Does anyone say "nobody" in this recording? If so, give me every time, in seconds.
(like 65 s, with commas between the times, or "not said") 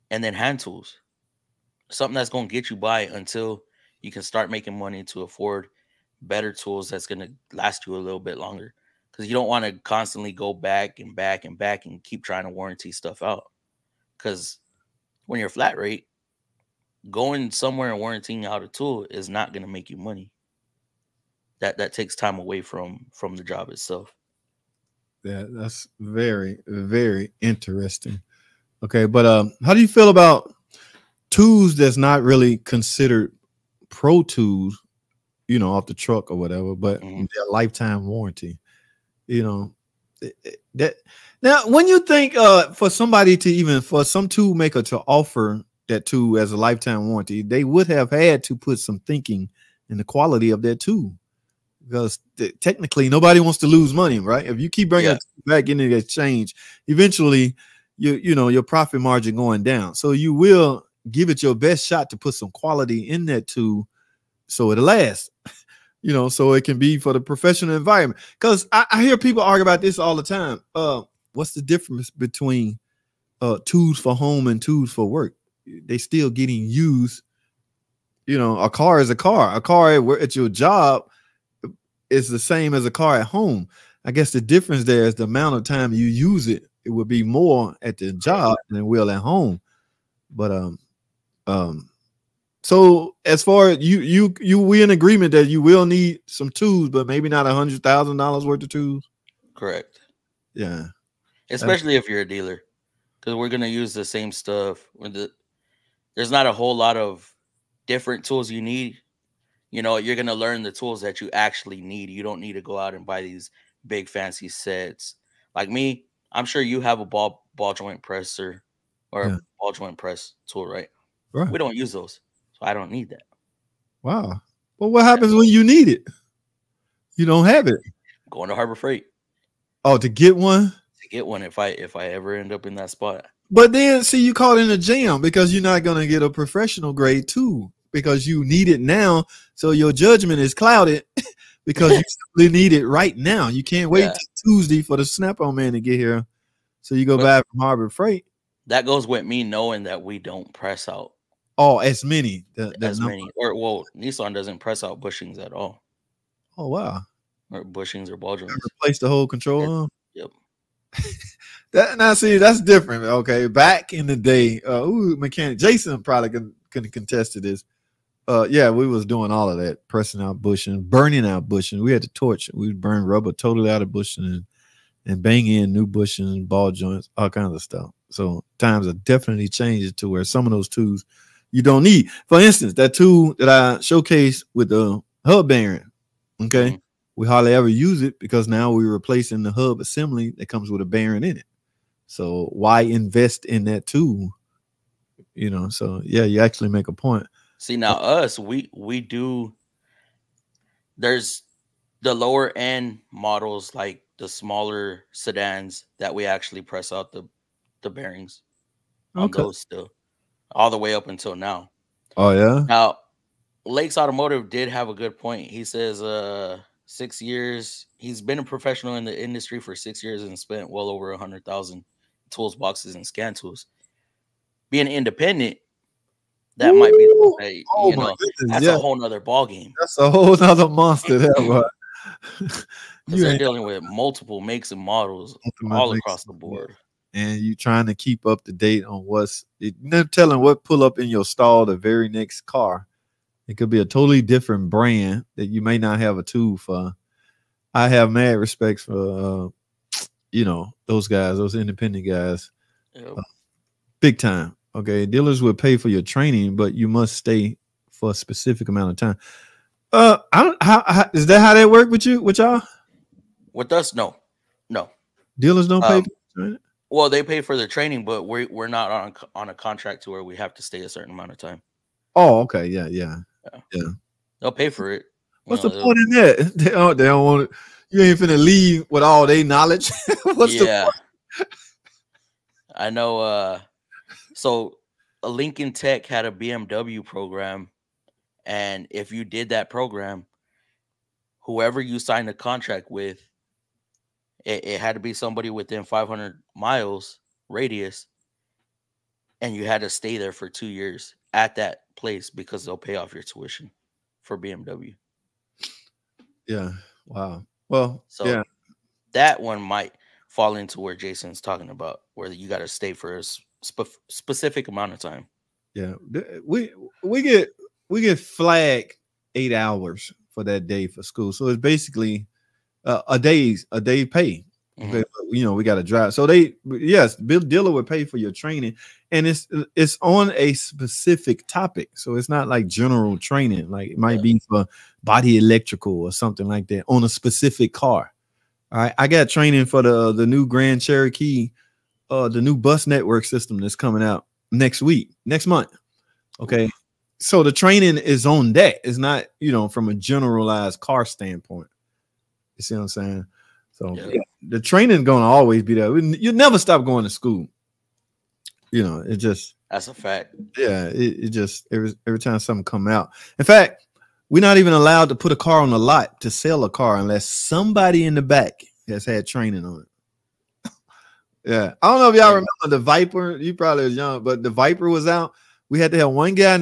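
53 s.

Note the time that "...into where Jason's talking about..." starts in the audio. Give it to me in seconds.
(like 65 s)
310 s.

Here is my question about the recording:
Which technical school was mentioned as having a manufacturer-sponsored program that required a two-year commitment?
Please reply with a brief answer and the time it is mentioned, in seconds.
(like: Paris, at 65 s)
Lincoln Tech, at 285 s.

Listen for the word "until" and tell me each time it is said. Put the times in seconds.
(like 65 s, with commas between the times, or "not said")
3 s, 211 s.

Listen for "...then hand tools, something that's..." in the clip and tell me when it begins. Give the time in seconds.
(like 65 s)
0 s.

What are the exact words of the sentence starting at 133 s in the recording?
But then see you caught in a jam because you're not gonna get a professional grade too because you need it now.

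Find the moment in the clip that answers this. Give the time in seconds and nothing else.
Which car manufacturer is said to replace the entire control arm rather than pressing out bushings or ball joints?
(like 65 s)
153 s.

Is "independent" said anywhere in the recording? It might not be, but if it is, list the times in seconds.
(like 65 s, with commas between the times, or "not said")
224 s, 251 s.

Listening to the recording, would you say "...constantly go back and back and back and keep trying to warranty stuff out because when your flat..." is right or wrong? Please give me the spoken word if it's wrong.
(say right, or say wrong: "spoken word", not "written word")
right.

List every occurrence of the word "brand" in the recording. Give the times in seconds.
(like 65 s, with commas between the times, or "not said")
244 s.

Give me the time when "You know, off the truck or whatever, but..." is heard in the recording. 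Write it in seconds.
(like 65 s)
35 s.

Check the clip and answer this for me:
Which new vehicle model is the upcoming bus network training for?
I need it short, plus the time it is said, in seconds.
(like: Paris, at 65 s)
Grand Cherokee, at 340 s.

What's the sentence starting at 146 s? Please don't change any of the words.
So you go but, back from Harbor Freight.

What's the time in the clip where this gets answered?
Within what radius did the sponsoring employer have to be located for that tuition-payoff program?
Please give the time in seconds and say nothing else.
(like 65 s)
295 s.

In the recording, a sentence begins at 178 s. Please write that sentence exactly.
So times are definitely changed to where some of those tools – you don't need.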